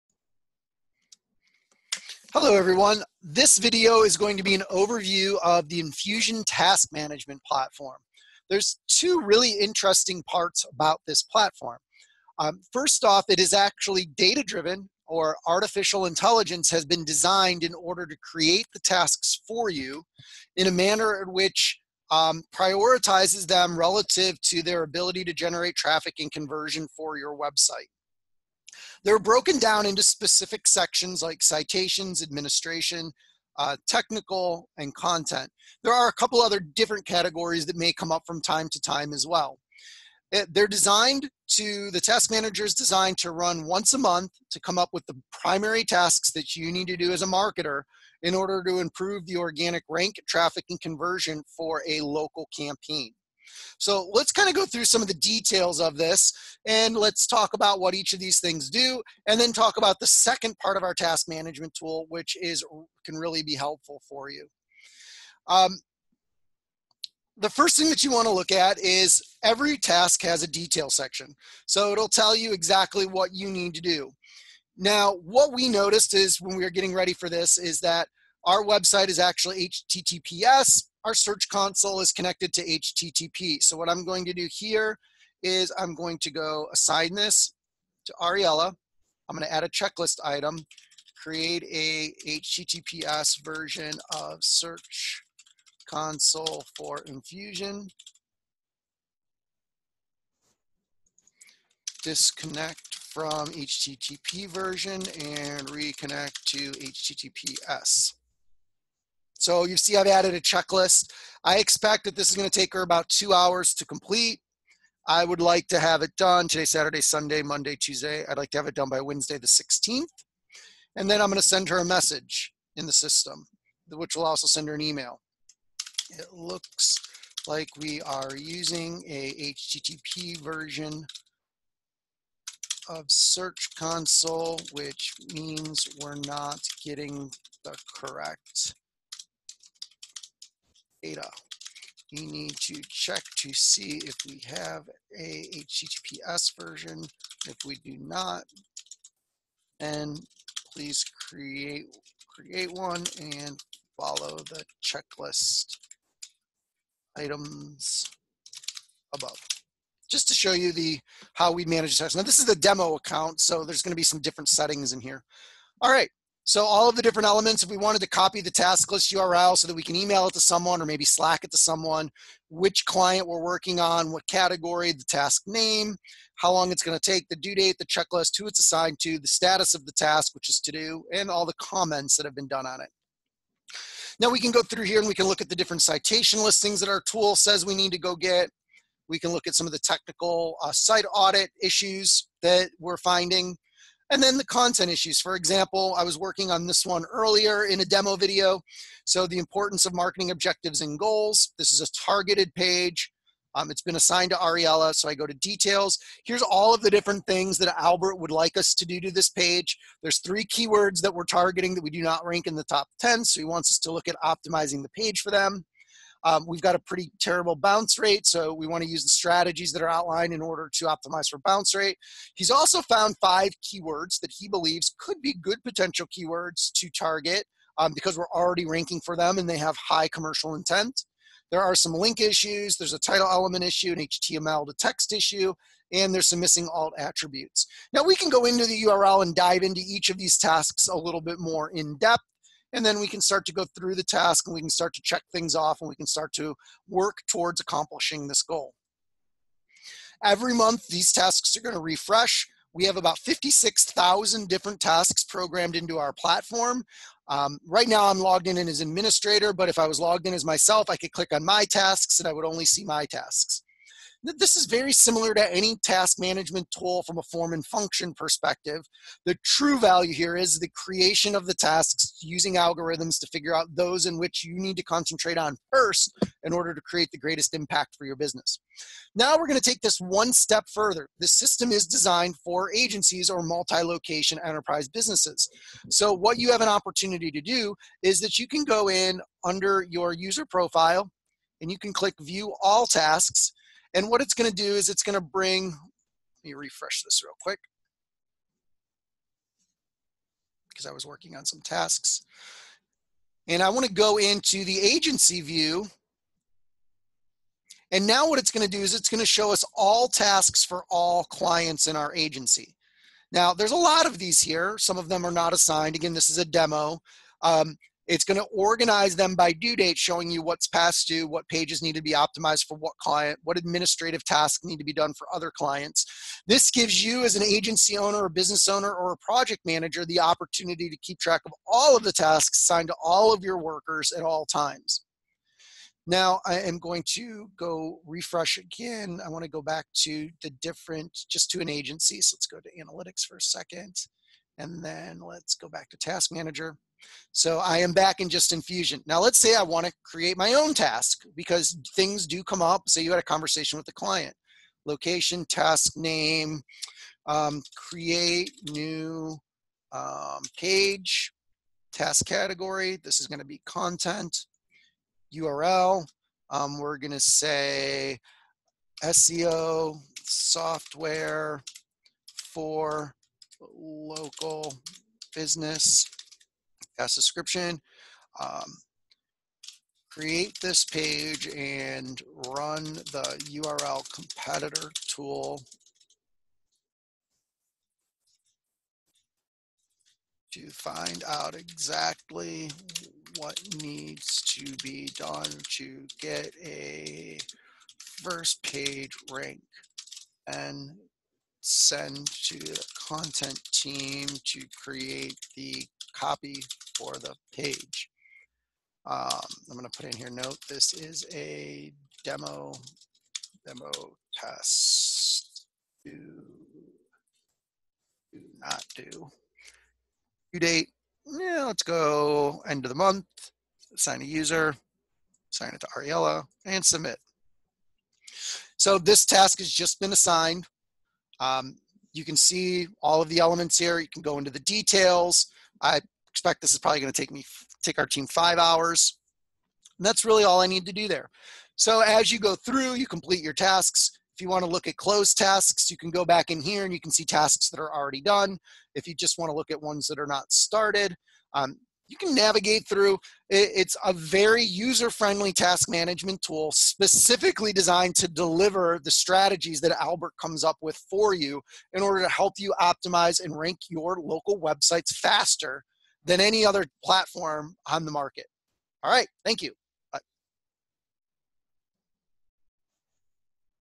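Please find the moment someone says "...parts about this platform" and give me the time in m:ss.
0:10.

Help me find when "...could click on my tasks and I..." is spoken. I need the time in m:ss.
4:20.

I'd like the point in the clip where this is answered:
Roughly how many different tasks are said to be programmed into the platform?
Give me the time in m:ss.
4:13.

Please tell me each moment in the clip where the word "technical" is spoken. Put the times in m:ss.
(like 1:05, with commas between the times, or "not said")
0:33, 3:09.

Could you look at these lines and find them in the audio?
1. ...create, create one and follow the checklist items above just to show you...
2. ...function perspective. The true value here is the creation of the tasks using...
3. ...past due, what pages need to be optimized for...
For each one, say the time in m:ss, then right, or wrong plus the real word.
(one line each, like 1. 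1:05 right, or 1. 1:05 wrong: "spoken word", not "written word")
1. 2:31 right
2. 4:27 right
3. 5:20 right.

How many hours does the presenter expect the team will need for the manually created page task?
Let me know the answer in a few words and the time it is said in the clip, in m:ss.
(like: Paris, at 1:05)
5, at 7:18.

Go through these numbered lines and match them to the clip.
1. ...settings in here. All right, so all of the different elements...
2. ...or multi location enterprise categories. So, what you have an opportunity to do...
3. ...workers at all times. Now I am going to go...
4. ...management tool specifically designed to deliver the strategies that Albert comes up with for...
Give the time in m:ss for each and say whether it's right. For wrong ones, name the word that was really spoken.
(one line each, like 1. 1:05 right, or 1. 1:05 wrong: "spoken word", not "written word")
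1. 2:44 right
2. 4:43 wrong: "businesses", not "categories"
3. 5:33 right
4. 7:35 right.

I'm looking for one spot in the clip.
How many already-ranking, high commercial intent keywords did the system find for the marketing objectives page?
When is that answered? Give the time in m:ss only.
3:43.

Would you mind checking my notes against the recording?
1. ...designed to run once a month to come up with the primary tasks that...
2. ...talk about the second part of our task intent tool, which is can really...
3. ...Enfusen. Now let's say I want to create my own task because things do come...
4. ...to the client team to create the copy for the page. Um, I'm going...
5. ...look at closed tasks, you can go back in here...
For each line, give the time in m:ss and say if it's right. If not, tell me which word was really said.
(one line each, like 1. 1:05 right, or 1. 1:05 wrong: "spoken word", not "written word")
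1. 0:42 right
2. 0:59 wrong: "management", not "intent"
3. 5:48 right
4. 6:42 wrong: "content", not "client"
5. 7:24 right.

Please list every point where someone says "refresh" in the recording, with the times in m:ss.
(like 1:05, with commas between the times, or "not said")
4:11, 4:56, 5:38.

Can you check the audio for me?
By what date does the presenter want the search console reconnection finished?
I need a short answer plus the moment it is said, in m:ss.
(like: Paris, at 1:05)
Wednesday the 16th, at 1:59.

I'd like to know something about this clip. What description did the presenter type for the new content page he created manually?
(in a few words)
SEO software for local business.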